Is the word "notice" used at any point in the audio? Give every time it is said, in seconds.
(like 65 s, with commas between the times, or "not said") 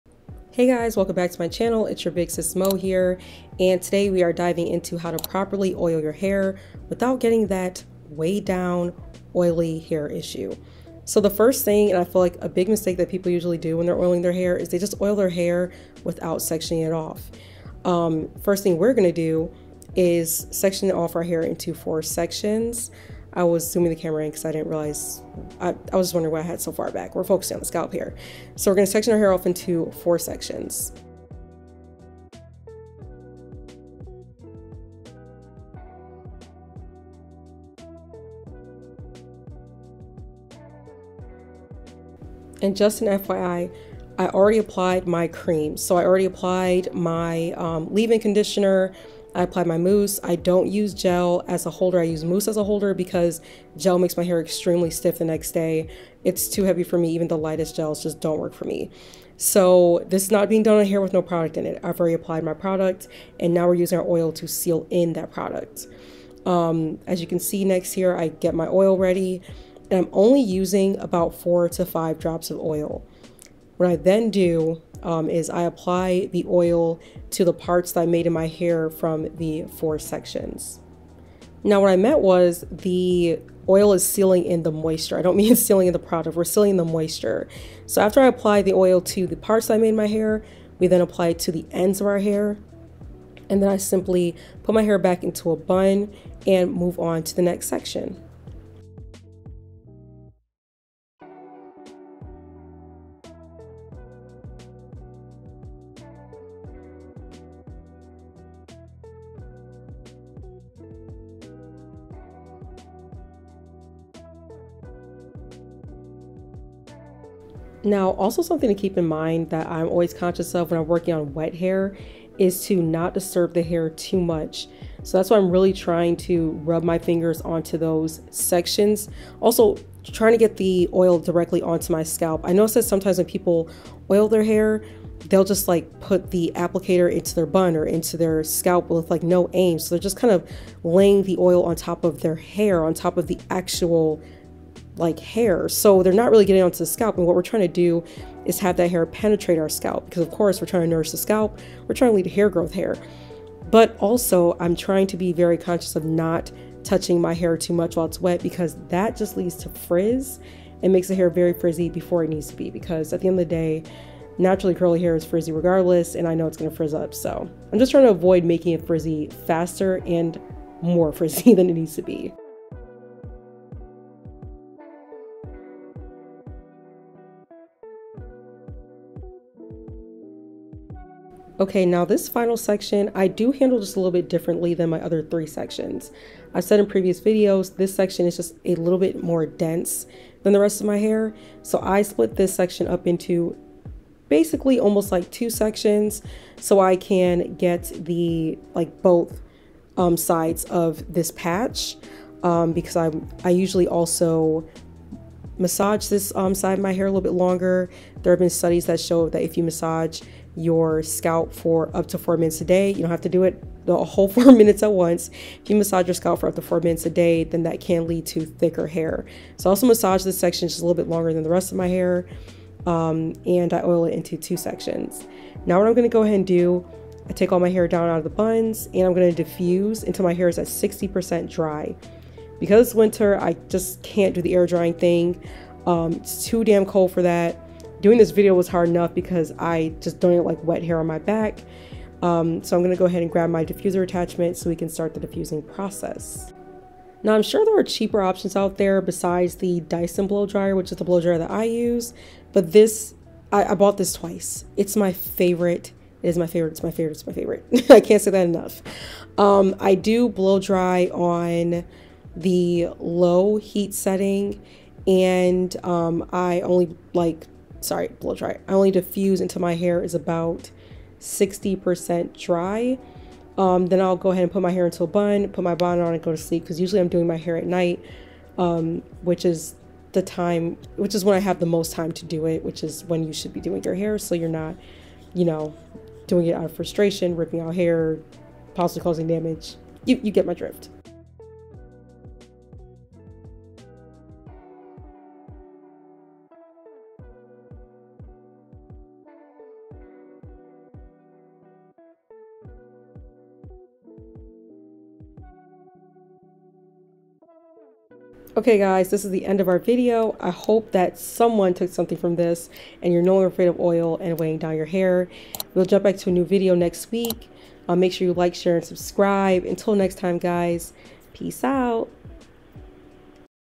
132 s.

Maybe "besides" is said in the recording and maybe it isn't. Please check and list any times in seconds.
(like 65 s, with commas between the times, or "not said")
249 s.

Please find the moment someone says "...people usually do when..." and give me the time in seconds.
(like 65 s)
13 s.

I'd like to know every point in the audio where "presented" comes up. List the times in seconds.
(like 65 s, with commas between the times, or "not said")
not said.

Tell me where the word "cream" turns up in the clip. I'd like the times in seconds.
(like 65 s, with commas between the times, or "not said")
45 s.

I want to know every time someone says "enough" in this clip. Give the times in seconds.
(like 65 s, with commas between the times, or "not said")
238 s, 258 s.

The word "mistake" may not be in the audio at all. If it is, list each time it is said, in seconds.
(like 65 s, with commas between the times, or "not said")
12 s.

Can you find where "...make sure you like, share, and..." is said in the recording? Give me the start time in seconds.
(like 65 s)
317 s.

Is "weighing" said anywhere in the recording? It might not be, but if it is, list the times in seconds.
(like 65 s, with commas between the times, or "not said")
314 s.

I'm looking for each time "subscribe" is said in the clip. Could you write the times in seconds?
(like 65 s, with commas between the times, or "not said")
318 s.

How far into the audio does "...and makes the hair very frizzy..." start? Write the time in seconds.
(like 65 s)
160 s.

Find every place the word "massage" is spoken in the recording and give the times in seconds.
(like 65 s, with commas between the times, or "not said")
205 s, 209 s, 215 s, 219 s.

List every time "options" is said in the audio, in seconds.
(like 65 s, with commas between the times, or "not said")
248 s.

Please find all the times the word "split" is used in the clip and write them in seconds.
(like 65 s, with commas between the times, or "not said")
192 s.